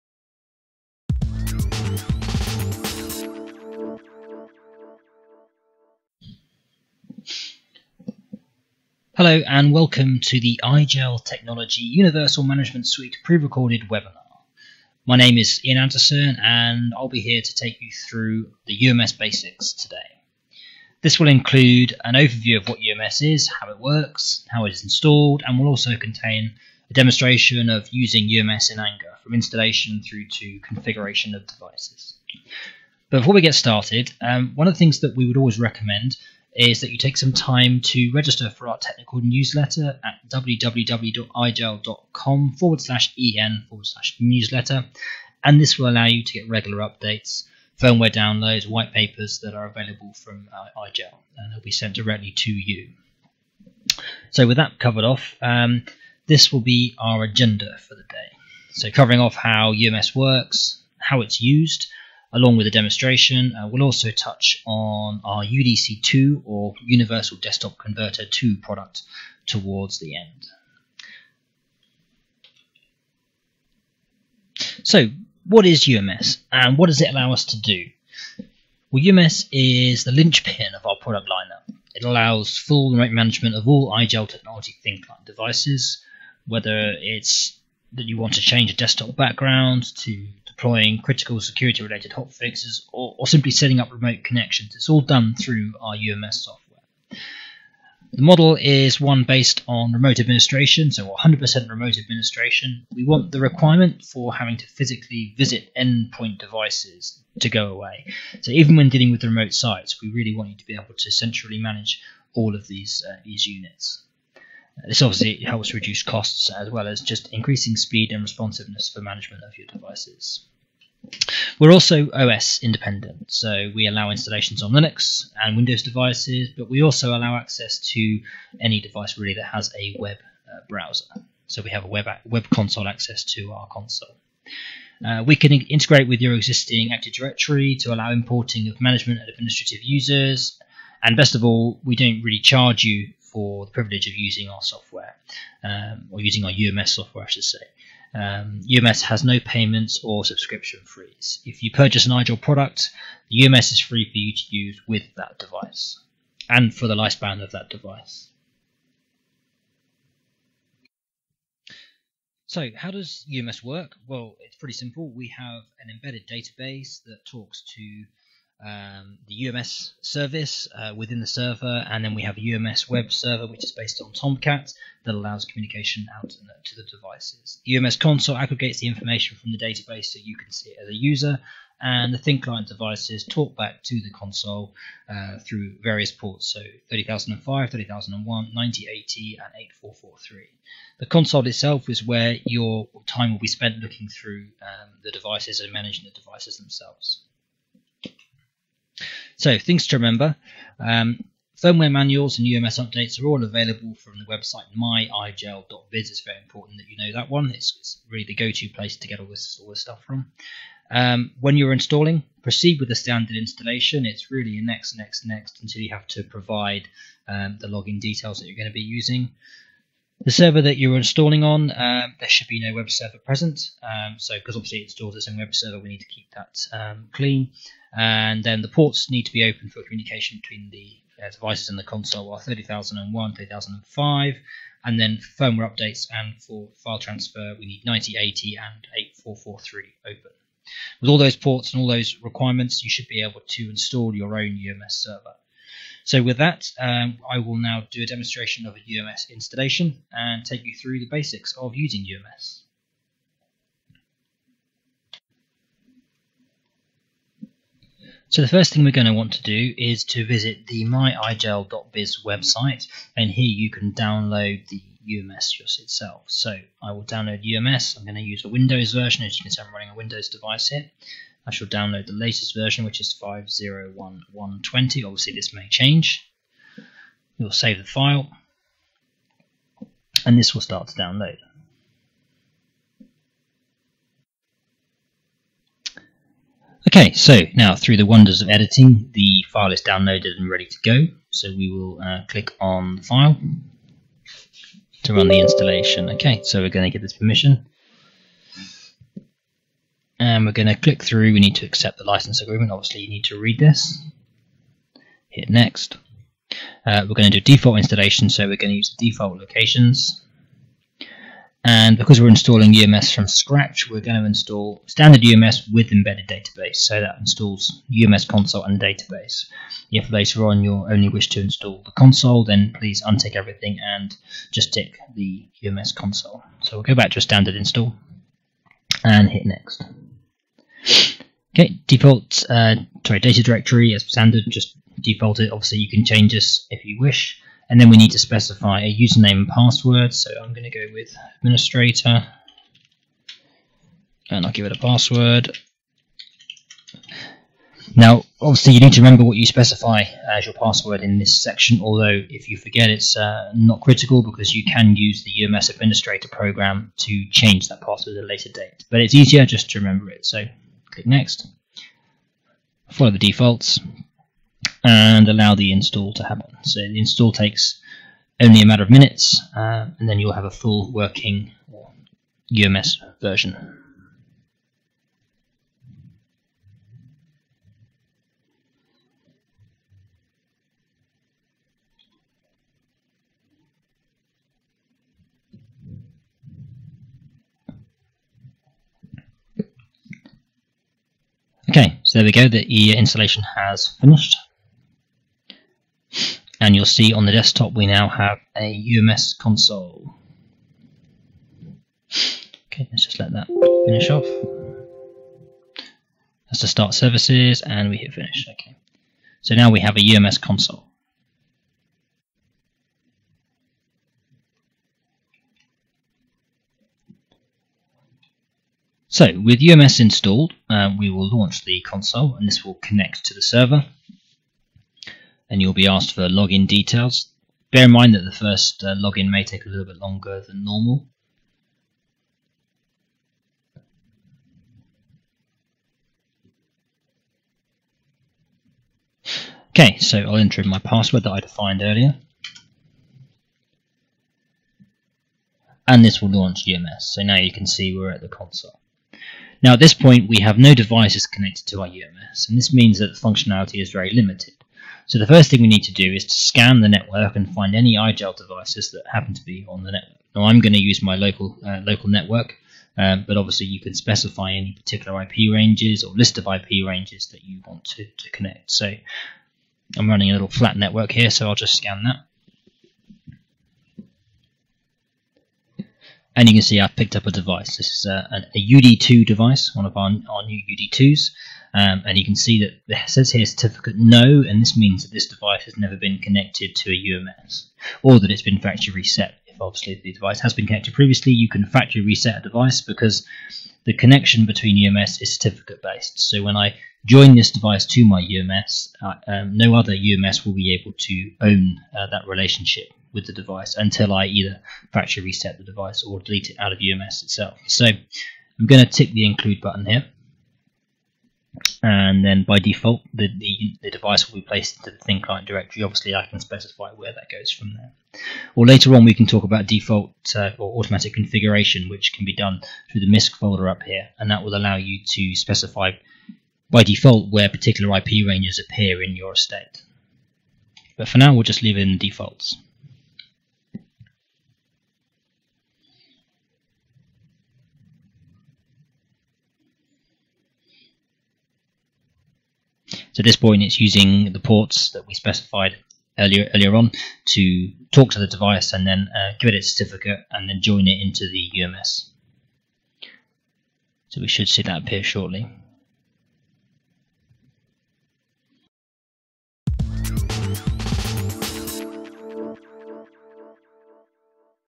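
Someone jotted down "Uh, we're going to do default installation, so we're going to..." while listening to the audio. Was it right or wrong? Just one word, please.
right.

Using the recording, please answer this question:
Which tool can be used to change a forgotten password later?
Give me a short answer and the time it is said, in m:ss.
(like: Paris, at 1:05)
UMS administrator, at 5:55.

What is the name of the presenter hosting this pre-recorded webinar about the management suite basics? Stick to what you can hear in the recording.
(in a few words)
Ian Anderson.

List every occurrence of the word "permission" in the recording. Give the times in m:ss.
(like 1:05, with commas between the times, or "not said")
4:57.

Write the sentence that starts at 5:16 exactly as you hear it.
So that installs UMS console and database.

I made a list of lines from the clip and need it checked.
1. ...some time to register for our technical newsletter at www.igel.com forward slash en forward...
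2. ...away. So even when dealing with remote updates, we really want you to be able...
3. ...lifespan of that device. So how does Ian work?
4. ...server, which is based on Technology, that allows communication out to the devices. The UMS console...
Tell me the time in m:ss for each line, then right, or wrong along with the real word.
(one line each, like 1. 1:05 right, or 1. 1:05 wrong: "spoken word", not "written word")
1. 0:37 right
2. 1:47 wrong: "sites", not "updates"
3. 2:36 wrong: "UMS", not "Ian"
4. 2:53 wrong: "Tomcat", not "Technology".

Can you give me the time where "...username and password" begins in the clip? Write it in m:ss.
5:38.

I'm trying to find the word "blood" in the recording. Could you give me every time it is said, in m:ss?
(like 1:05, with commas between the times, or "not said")
not said.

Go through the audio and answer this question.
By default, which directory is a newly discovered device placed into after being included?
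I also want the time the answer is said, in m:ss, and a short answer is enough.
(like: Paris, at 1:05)
thin client directory, at 8:35.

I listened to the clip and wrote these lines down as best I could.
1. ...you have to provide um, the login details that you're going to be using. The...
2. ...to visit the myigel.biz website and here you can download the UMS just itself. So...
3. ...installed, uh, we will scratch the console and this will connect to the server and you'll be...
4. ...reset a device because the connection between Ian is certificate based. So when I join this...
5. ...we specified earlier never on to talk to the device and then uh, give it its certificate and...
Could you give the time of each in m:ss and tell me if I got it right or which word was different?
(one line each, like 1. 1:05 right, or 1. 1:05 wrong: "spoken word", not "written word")
1. 3:35 right
2. 4:20 right
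3. 6:59 wrong: "launch", not "scratch"
4. 8:12 wrong: "UMS", not "Ian"
5. 9:05 wrong: "earlier", not "never".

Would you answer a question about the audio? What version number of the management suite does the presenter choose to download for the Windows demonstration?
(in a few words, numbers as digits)
501.120.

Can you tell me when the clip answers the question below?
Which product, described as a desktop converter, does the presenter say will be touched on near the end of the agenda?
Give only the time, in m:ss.
1:05.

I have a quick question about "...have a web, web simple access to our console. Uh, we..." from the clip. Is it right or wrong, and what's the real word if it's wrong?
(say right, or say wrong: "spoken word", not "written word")
wrong: "console", not "simple".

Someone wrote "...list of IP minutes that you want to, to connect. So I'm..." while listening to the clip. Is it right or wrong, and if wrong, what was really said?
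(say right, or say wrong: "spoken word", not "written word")
wrong: "ranges", not "minutes".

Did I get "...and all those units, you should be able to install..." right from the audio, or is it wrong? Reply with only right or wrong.
wrong.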